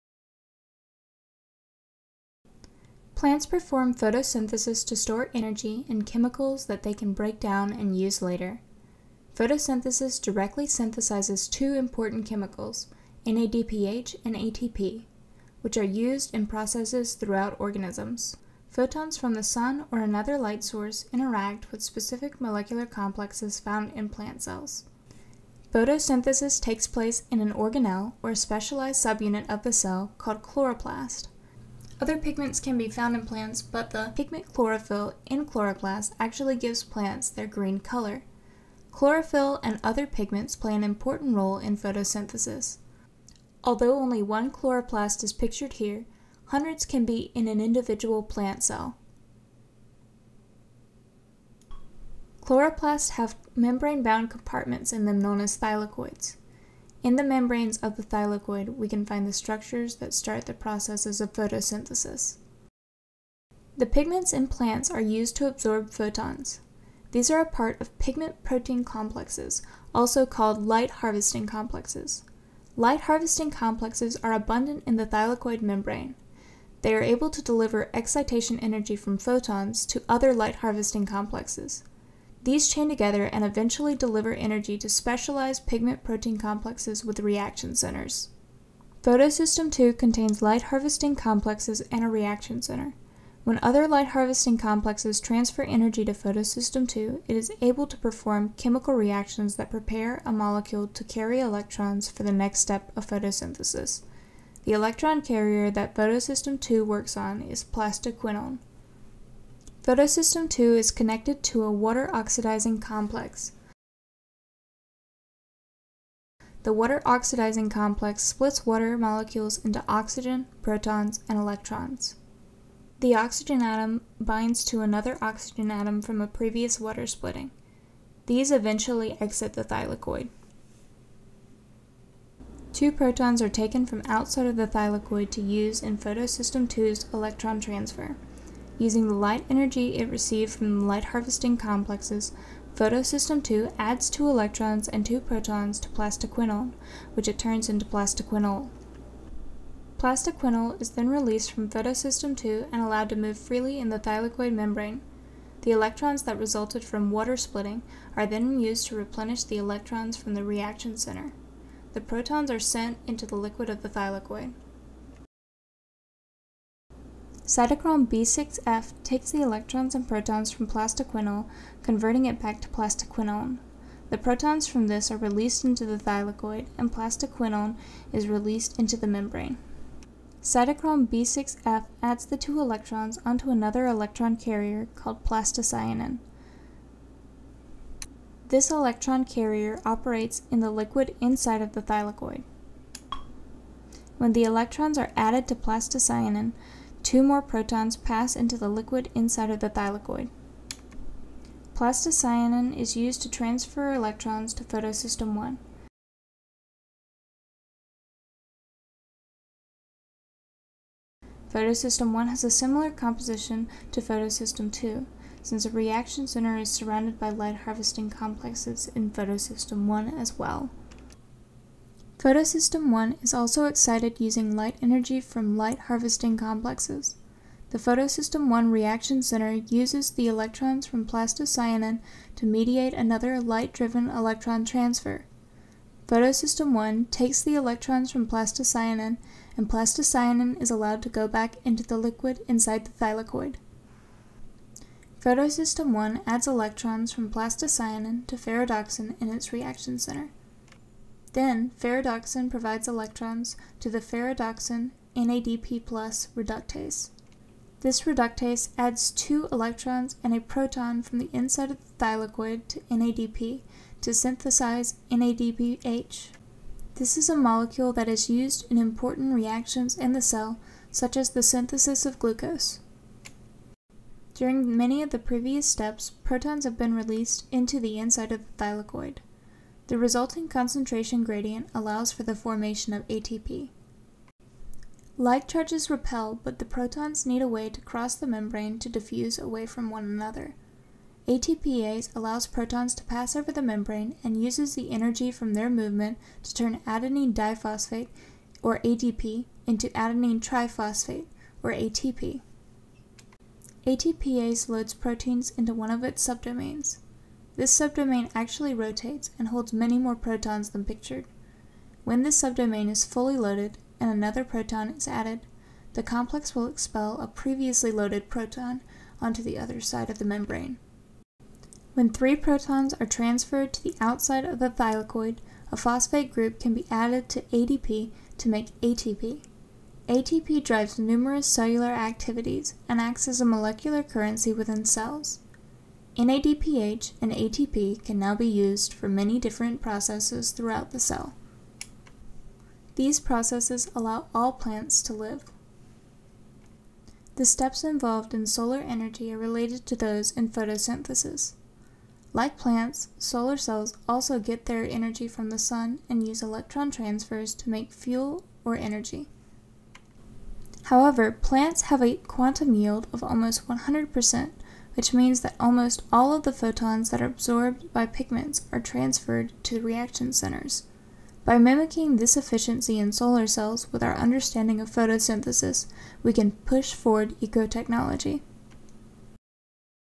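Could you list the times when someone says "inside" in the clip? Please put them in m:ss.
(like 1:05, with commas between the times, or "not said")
3:11, 3:19, 4:02, 4:21, 4:37.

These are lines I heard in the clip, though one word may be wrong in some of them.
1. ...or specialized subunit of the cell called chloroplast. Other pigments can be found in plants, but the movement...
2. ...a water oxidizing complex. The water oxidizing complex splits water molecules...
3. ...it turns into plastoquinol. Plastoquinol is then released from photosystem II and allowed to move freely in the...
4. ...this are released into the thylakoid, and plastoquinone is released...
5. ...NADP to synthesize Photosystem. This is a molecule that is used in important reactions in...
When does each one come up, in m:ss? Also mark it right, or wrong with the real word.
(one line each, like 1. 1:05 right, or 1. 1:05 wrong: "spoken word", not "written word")
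1. 0:28 wrong: "pigment", not "movement"
2. 1:51 right
3. 2:27 right
4. 2:54 right
5. 4:22 wrong: "NADPH", not "Photosystem".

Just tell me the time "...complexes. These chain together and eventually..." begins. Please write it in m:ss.
1:21.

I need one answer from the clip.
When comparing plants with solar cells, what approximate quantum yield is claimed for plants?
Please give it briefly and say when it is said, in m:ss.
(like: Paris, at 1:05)
almost 100%, at 6:03.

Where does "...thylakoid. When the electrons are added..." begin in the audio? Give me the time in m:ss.
3:11.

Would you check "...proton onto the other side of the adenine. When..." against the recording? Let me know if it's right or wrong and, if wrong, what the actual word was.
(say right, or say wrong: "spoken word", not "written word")
wrong: "membrane", not "adenine".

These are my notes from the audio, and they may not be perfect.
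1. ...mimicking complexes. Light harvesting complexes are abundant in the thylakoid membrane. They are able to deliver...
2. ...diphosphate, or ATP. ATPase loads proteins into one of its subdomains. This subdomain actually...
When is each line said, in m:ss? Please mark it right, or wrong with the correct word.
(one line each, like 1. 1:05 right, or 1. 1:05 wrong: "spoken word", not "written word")
1. 1:11 wrong: "harvesting", not "mimicking"
2. 5:00 wrong: "triphosphate", not "diphosphate".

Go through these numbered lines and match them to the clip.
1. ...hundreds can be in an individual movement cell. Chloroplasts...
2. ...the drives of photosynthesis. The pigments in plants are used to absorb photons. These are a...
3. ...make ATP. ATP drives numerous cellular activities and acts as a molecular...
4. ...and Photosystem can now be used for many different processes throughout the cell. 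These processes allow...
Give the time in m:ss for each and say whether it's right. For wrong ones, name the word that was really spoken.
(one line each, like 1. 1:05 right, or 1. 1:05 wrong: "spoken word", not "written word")
1. 0:46 wrong: "plant", not "movement"
2. 1:00 wrong: "processes", not "drives"
3. 5:28 right
4. 5:37 wrong: "ATP", not "Photosystem".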